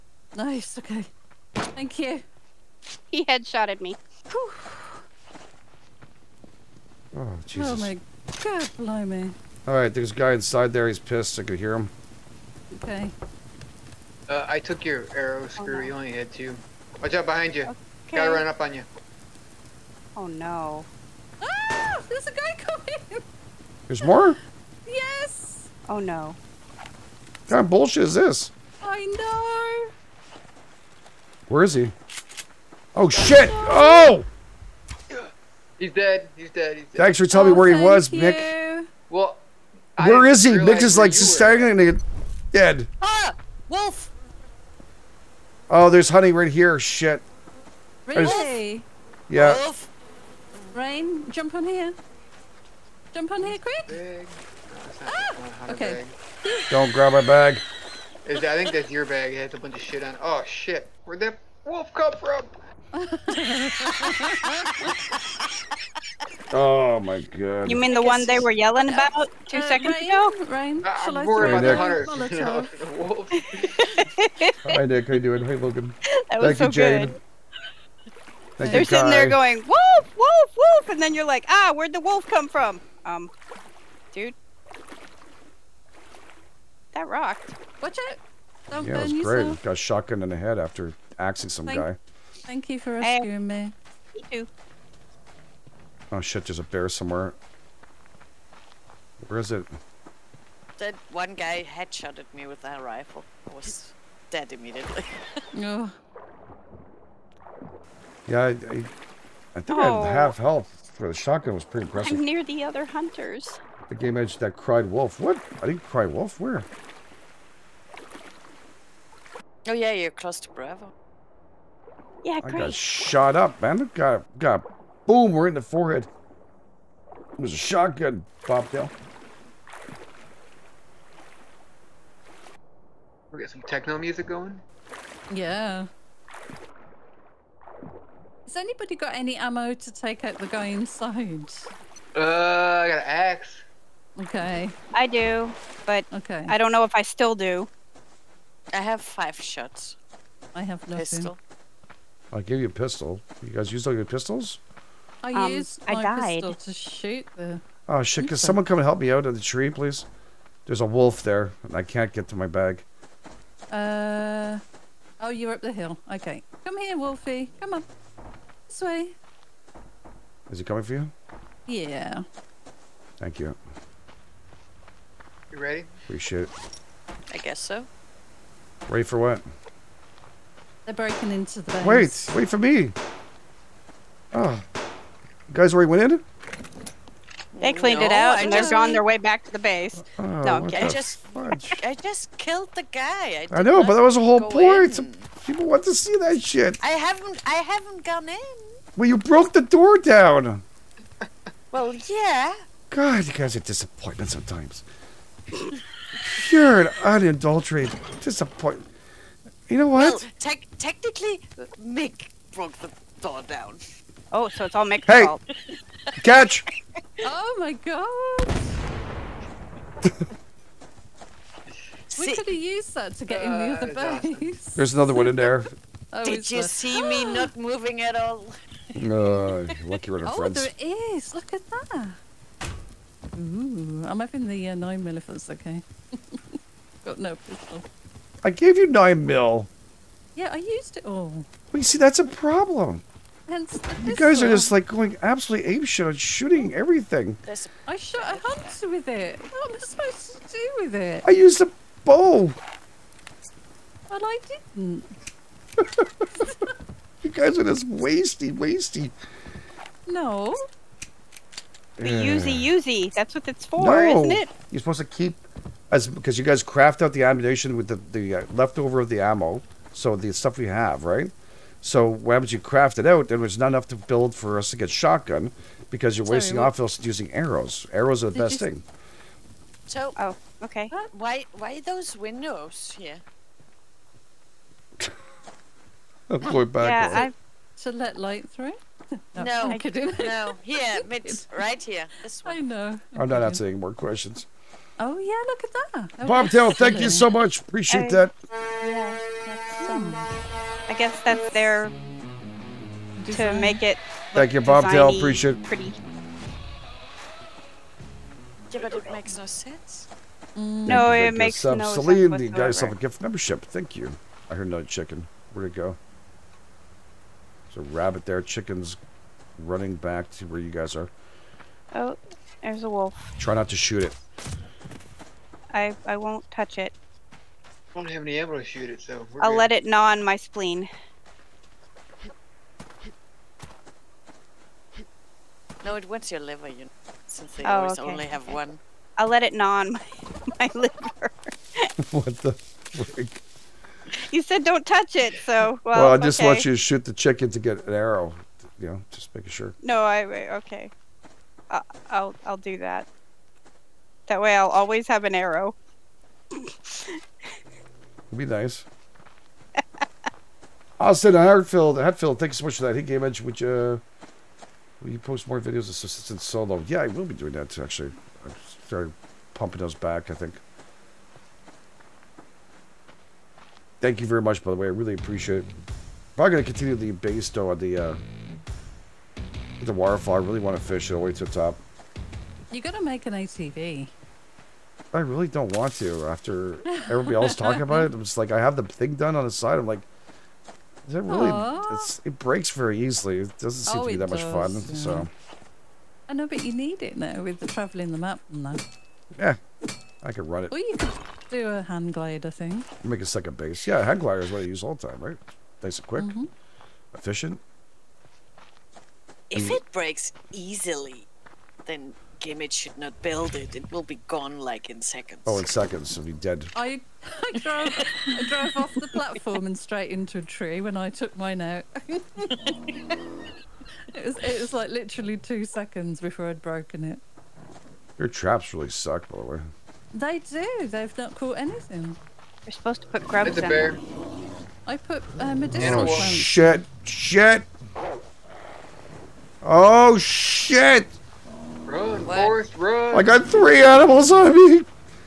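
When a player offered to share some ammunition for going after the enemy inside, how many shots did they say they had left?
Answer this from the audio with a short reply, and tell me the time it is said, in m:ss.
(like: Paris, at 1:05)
5, at 2:29.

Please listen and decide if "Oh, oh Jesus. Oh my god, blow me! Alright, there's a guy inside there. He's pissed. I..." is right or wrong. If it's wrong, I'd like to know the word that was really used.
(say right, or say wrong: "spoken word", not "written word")
right.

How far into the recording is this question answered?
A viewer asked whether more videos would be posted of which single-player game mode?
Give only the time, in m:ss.
6:05.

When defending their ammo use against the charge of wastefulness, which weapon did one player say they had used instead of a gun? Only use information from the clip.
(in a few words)
a bow.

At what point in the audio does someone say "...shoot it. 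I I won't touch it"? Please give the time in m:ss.
5:23.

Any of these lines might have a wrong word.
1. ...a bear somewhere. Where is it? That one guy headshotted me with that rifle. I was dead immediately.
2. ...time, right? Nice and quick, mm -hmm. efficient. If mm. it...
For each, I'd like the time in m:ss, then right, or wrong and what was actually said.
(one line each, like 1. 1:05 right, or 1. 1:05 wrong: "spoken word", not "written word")
1. 1:36 right
2. 6:45 right.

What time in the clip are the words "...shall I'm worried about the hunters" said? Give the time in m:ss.
1:11.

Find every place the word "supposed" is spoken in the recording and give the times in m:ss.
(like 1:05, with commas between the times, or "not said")
4:09, 4:24, 7:12.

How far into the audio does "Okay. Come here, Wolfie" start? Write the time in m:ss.
2:46.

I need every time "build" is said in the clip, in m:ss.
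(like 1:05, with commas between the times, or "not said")
4:33, 6:53.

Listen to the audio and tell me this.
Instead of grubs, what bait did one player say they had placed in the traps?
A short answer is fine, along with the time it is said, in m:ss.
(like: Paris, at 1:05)
medicinal ones, at 7:15.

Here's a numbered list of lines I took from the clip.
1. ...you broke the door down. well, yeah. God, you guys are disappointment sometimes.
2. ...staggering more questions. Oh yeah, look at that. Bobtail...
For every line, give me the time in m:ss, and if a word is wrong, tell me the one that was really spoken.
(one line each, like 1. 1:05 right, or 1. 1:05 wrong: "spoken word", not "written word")
1. 3:19 right
2. 4:53 wrong: "answering", not "staggering".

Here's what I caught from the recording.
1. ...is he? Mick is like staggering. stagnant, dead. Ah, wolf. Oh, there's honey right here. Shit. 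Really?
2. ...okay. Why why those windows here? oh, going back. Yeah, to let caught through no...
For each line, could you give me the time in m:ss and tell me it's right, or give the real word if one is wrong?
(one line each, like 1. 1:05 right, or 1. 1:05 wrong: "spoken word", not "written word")
1. 0:40 right
2. 4:40 wrong: "light", not "caught".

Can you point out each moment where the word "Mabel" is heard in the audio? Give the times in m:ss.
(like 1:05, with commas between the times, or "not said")
not said.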